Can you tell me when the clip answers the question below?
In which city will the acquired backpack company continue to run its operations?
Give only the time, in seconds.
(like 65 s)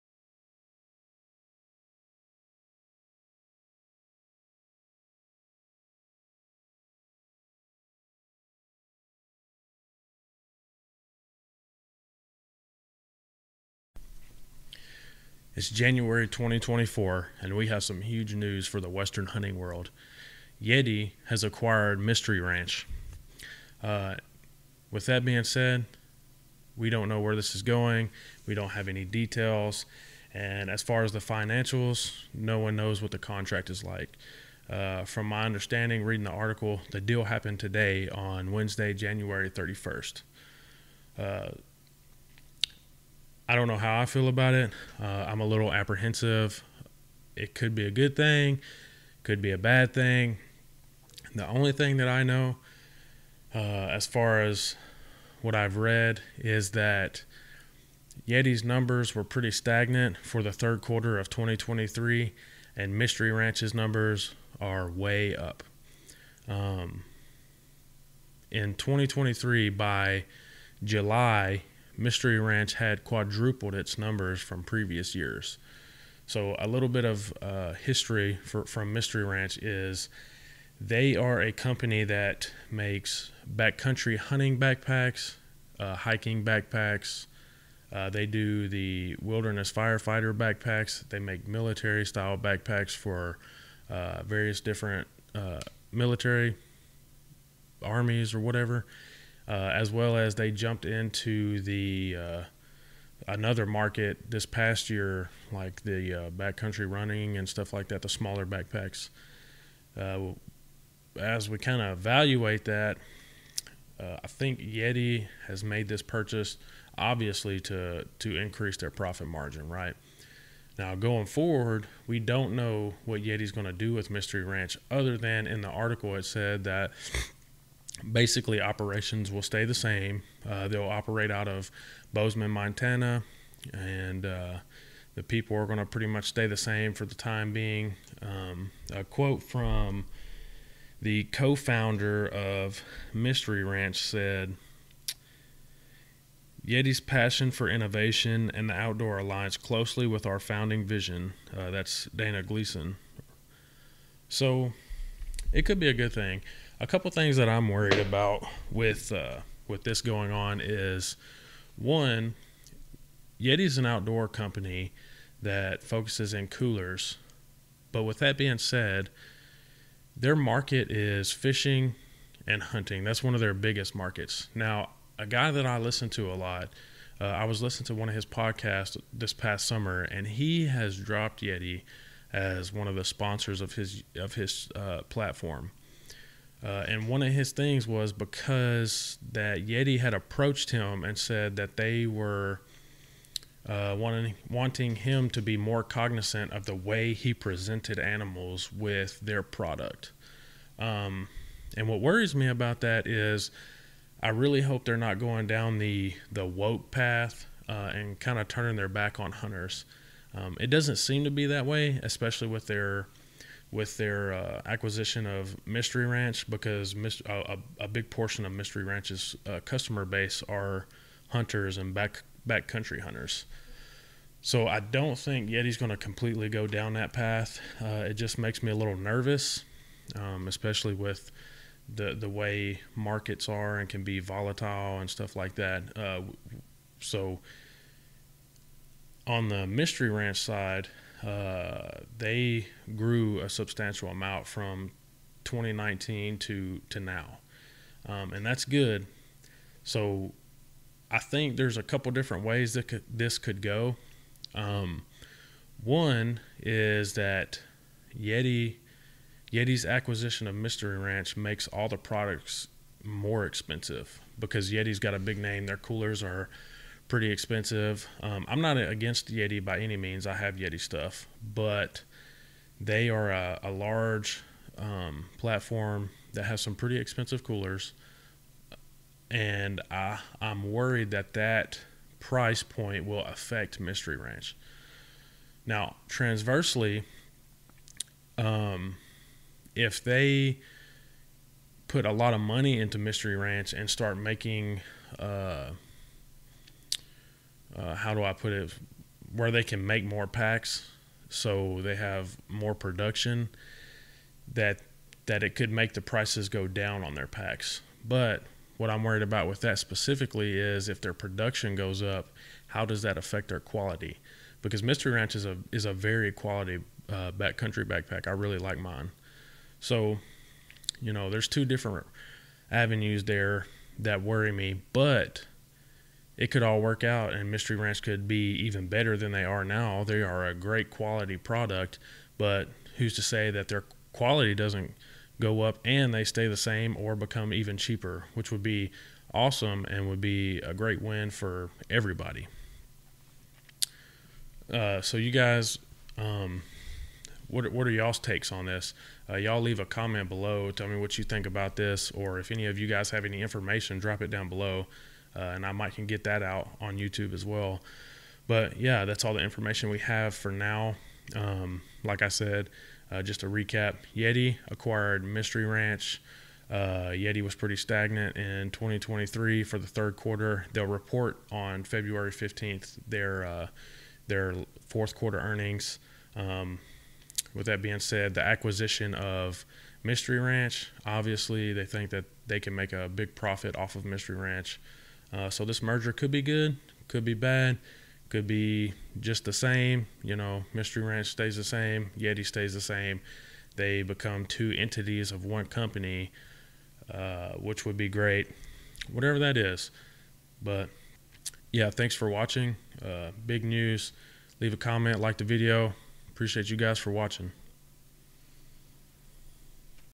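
132 s.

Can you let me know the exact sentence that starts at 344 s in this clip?
Uh, so you guys, um, what what are y'all's takes on this?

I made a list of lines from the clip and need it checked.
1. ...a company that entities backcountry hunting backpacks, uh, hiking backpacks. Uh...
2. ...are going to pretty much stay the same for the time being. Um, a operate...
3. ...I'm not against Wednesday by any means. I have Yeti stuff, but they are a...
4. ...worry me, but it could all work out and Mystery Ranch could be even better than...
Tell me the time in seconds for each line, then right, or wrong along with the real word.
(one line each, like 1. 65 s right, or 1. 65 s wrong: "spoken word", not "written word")
1. 81 s wrong: "makes", not "entities"
2. 135 s wrong: "quote", not "operate"
3. 268 s wrong: "Yeti", not "Wednesday"
4. 324 s right.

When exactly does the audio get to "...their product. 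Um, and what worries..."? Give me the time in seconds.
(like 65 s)
199 s.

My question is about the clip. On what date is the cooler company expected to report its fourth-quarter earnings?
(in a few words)
February 15.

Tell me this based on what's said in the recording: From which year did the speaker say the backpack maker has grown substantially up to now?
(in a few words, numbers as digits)
2019.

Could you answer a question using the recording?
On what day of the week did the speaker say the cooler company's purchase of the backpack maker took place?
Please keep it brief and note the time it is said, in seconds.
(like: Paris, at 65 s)
Wednesday, at 38 s.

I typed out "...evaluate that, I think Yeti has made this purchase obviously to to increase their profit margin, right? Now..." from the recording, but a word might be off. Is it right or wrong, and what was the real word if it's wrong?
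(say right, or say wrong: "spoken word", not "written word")
right.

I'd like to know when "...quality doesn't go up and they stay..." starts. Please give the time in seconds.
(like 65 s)
334 s.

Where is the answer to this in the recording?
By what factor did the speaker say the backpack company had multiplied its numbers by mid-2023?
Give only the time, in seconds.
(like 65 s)
73 s.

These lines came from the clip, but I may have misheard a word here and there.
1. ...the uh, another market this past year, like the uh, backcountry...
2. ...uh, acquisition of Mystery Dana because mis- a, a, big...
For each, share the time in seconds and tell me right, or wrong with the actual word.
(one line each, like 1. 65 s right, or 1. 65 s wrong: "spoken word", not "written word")
1. 101 s right
2. 214 s wrong: "Ranch", not "Dana".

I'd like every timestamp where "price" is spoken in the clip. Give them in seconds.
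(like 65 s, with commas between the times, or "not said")
282 s, 306 s.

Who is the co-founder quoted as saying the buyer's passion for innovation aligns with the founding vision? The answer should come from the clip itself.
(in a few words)
Dana Gleason.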